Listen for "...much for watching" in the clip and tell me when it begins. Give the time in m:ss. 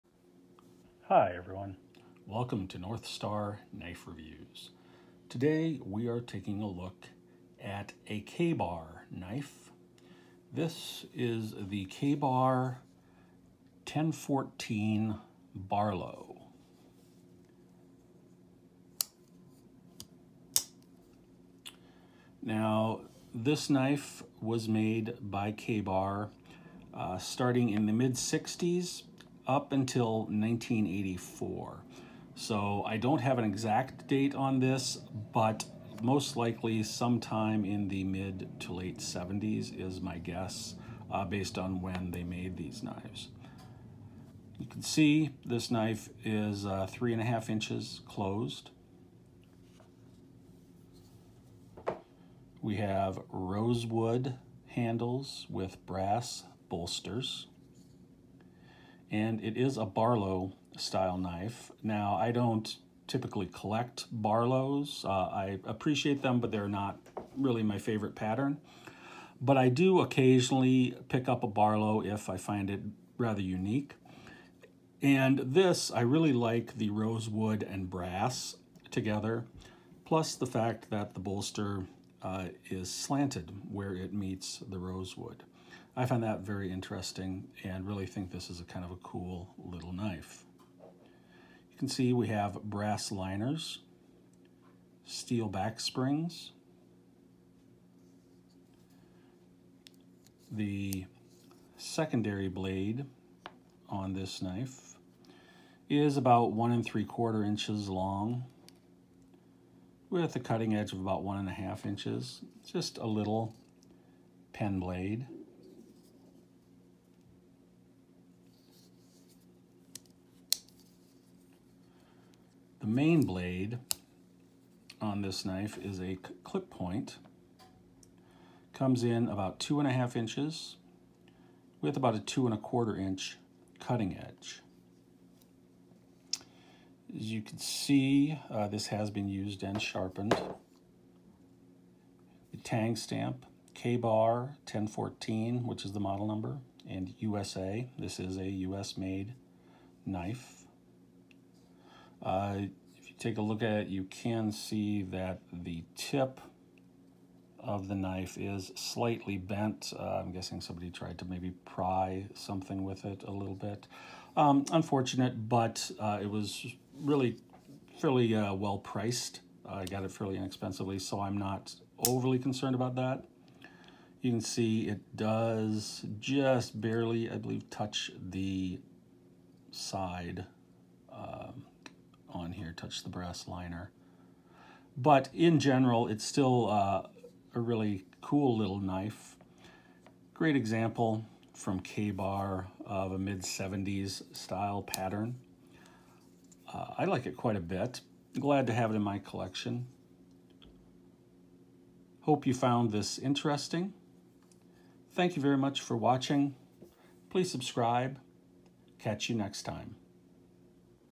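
3:25.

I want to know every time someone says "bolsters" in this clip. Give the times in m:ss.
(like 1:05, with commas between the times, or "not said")
0:56, 1:21.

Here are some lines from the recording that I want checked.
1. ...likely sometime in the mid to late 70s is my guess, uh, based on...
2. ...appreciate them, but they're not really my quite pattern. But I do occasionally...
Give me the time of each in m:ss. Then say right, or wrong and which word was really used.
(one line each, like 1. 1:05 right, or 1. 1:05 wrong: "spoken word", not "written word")
1. 0:36 right
2. 1:05 wrong: "favorite", not "quite".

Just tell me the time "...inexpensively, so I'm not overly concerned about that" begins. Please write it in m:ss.
2:50.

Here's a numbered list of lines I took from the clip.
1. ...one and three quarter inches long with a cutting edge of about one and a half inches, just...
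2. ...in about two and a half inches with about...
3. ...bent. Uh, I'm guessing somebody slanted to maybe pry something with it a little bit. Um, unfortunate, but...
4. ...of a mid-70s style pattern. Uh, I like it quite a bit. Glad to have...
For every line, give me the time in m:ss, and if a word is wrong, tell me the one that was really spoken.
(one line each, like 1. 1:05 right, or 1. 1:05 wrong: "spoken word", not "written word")
1. 1:46 right
2. 2:09 right
3. 2:39 wrong: "tried", not "slanted"
4. 3:12 right.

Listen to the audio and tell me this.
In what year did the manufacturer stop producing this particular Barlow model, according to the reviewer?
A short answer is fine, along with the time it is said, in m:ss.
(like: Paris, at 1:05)
1984, at 0:30.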